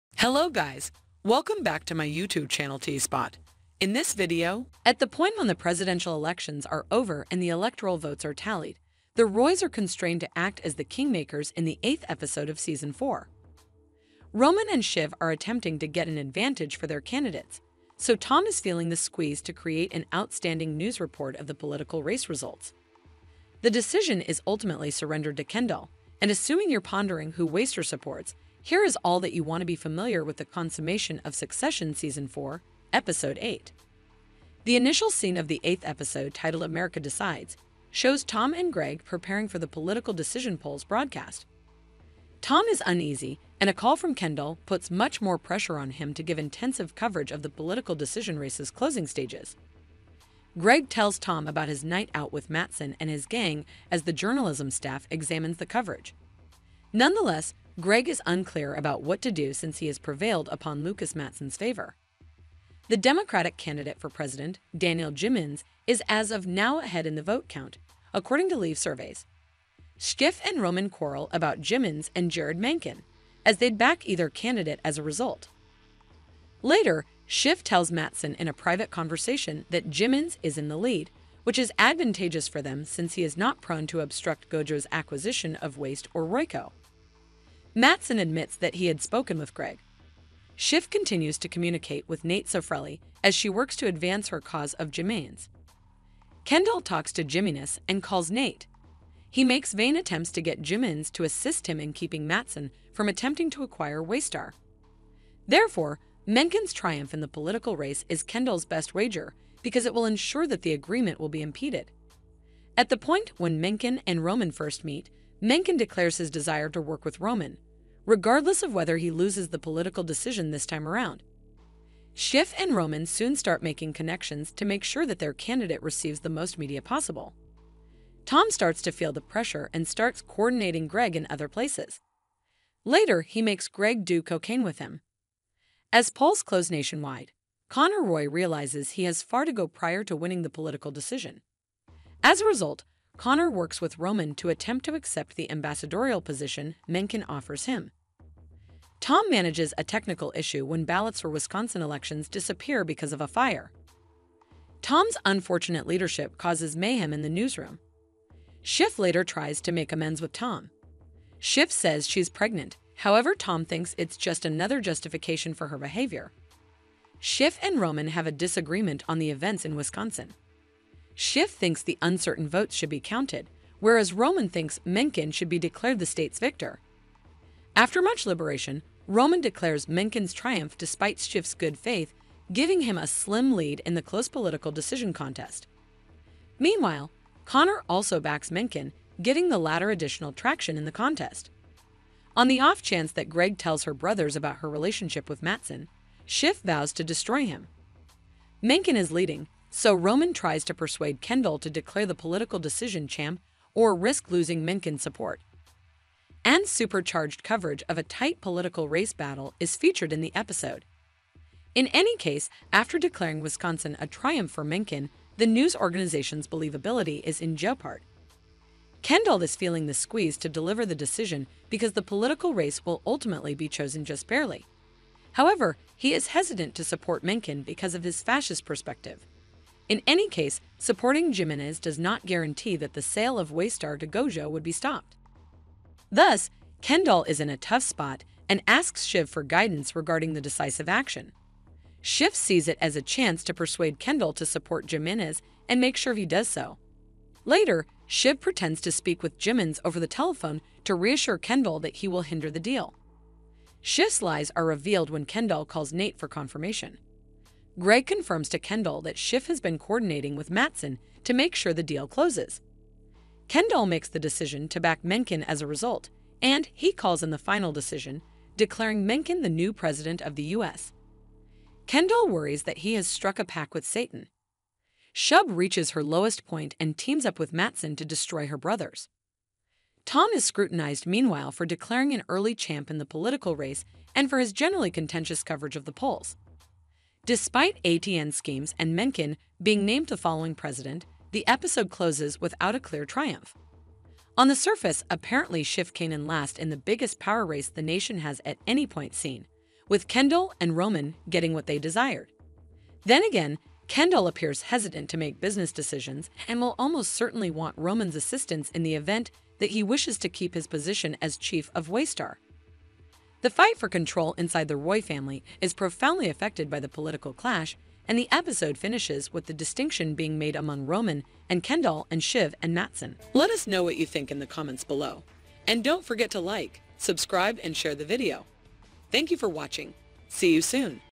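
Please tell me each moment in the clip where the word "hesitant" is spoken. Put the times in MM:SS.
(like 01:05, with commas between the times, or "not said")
03:46, 05:04.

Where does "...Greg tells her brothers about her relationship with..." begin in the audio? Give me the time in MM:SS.
03:13.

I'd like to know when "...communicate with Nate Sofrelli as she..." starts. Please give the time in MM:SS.
01:31.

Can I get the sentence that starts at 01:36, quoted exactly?
Kendall talks to Jimenez and calls Nate.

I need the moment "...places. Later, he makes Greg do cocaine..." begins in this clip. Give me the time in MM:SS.
02:11.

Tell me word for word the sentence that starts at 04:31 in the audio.
Kendall worries that he has struck a pact with Satan.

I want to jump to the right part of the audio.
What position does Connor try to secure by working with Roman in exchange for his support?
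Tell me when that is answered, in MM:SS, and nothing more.
02:25.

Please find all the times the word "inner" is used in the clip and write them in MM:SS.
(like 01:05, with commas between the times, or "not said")
not said.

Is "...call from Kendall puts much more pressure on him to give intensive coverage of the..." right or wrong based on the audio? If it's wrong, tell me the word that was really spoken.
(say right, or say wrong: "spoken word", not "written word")
right.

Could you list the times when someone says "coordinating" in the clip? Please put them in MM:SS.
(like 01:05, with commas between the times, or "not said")
02:10, 04:19.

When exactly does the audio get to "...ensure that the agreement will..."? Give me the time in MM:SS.
01:50.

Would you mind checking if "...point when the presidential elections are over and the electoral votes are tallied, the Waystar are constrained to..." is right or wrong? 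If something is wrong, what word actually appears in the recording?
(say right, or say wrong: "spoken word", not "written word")
wrong: "Roys", not "Waystar".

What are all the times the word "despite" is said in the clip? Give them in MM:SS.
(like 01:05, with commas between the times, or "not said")
03:00, 04:47.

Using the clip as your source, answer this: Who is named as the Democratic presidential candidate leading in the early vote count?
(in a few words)
Daniel Jimenez.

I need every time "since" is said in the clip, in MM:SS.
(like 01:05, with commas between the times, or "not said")
00:59, 01:22.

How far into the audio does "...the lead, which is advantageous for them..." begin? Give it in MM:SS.
01:20.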